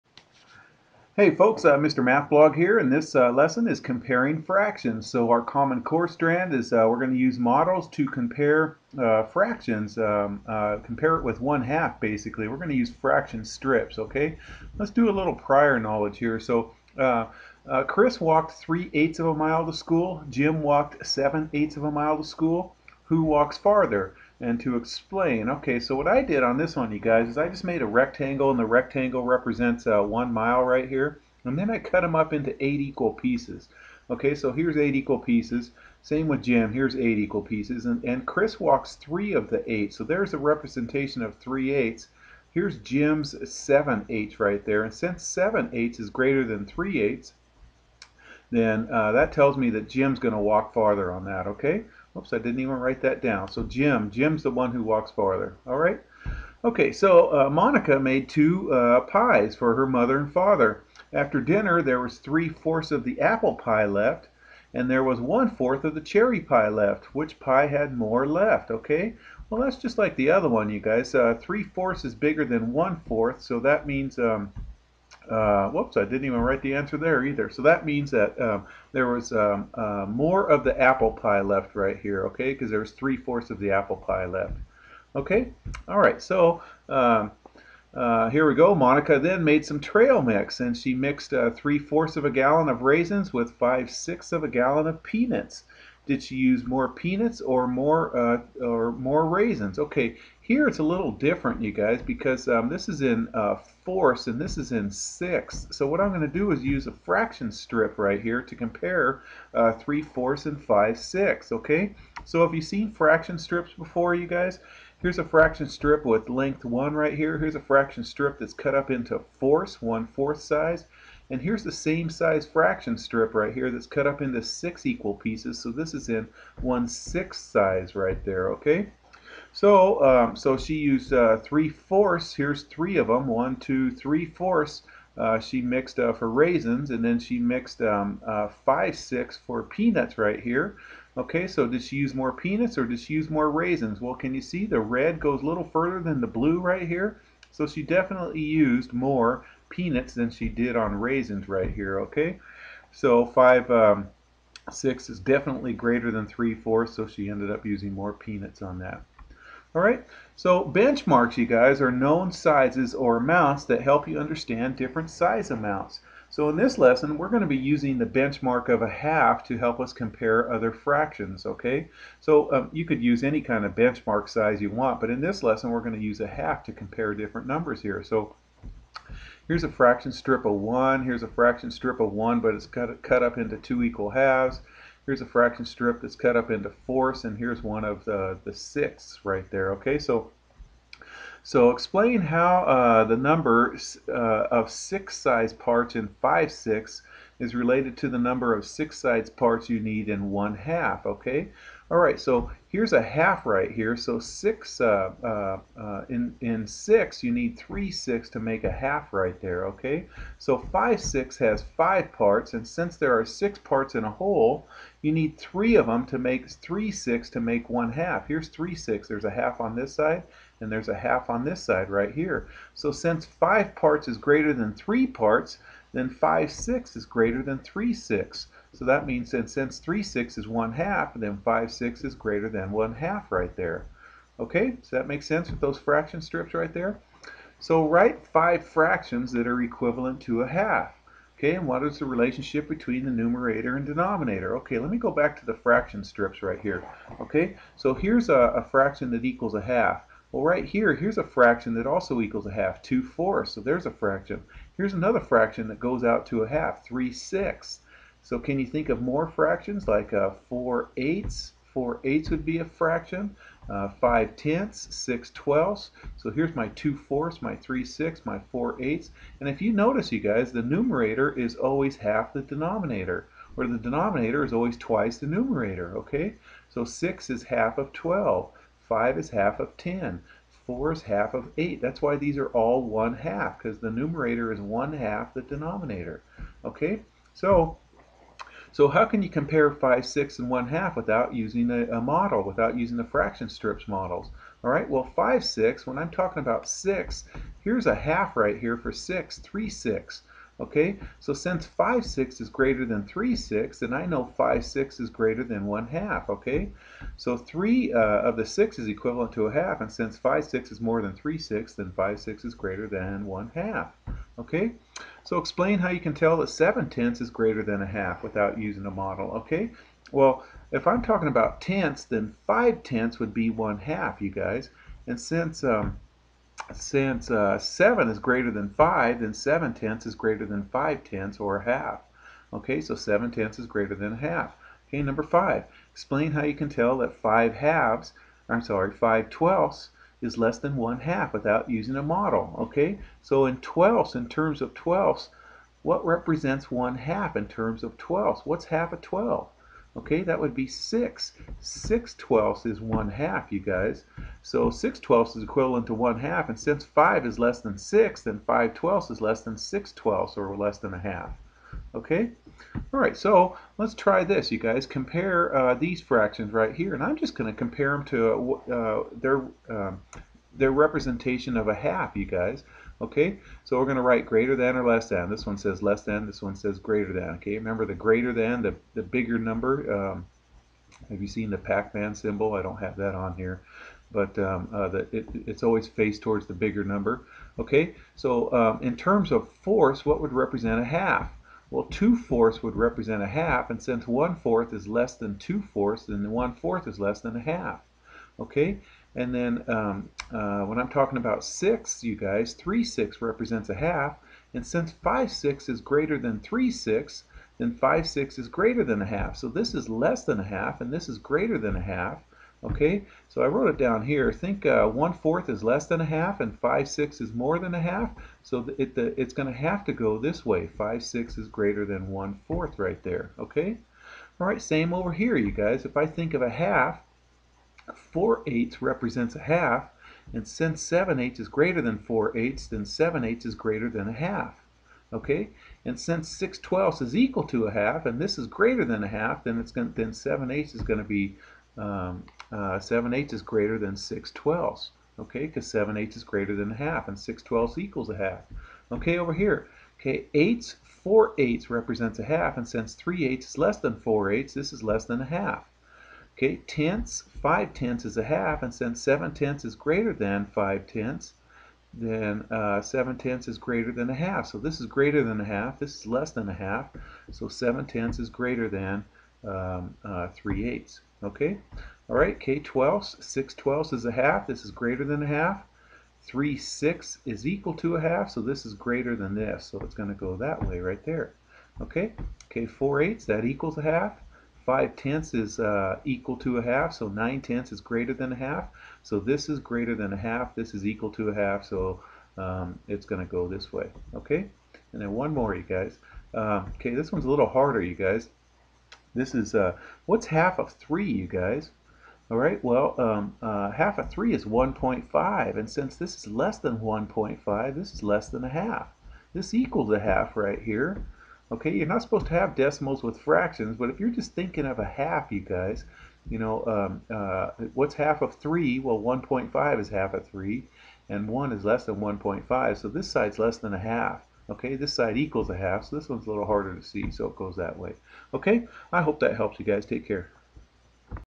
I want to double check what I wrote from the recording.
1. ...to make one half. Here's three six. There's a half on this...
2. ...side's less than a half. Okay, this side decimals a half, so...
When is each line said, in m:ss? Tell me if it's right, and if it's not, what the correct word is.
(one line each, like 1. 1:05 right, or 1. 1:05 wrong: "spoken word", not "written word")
1. 3:37 right
2. 8:43 wrong: "equals", not "decimals".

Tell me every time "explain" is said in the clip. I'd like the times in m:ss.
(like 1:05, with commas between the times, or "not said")
0:24, 3:11, 5:15, 5:35.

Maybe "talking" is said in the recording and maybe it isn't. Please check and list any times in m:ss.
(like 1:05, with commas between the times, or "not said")
4:56, 5:21, 6:40.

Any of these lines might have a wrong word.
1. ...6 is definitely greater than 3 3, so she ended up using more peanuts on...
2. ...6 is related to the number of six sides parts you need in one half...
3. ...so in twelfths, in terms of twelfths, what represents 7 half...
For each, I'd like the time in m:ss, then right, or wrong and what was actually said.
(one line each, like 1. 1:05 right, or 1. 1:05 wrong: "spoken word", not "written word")
1. 2:34 wrong: "4", not "3"
2. 3:16 right
3. 5:43 wrong: "1", not "7".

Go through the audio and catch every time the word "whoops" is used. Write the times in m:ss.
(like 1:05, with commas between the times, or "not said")
1:15.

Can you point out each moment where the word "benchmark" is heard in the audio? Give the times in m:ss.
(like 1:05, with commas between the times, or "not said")
2:40, 2:48, 2:53.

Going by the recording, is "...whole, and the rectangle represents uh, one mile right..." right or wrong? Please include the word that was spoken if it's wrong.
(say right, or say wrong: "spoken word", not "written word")
wrong: "rectangle", not "whole".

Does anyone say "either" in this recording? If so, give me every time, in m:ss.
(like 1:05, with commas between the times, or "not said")
1:17.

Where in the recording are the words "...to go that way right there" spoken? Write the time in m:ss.
8:00.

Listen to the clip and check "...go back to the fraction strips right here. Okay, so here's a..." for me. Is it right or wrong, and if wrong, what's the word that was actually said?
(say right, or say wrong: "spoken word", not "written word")
right.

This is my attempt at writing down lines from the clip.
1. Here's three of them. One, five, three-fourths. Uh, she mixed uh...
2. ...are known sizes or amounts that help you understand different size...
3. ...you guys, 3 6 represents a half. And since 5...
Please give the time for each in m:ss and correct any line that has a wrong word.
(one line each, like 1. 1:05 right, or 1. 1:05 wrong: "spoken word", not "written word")
1. 2:12 wrong: "two", not "five"
2. 2:41 right
3. 6:42 right.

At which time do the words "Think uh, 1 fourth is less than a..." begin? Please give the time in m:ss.
6:54.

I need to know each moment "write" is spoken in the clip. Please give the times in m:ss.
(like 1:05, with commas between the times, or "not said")
0:52, 1:16, 3:57, 6:14.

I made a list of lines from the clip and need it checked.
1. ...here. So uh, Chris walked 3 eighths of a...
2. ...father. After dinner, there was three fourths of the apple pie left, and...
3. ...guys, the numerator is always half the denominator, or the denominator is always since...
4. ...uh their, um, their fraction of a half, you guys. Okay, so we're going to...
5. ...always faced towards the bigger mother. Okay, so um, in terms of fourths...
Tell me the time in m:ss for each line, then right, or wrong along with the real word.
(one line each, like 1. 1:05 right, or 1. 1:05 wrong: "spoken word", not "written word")
1. 0:16 right
2. 1:00 right
3. 4:30 wrong: "twice", not "since"
4. 6:08 wrong: "representation", not "fraction"
5. 6:25 wrong: "number", not "mother".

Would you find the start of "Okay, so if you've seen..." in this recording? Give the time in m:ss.
1:51.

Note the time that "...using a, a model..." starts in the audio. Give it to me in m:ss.
4:51.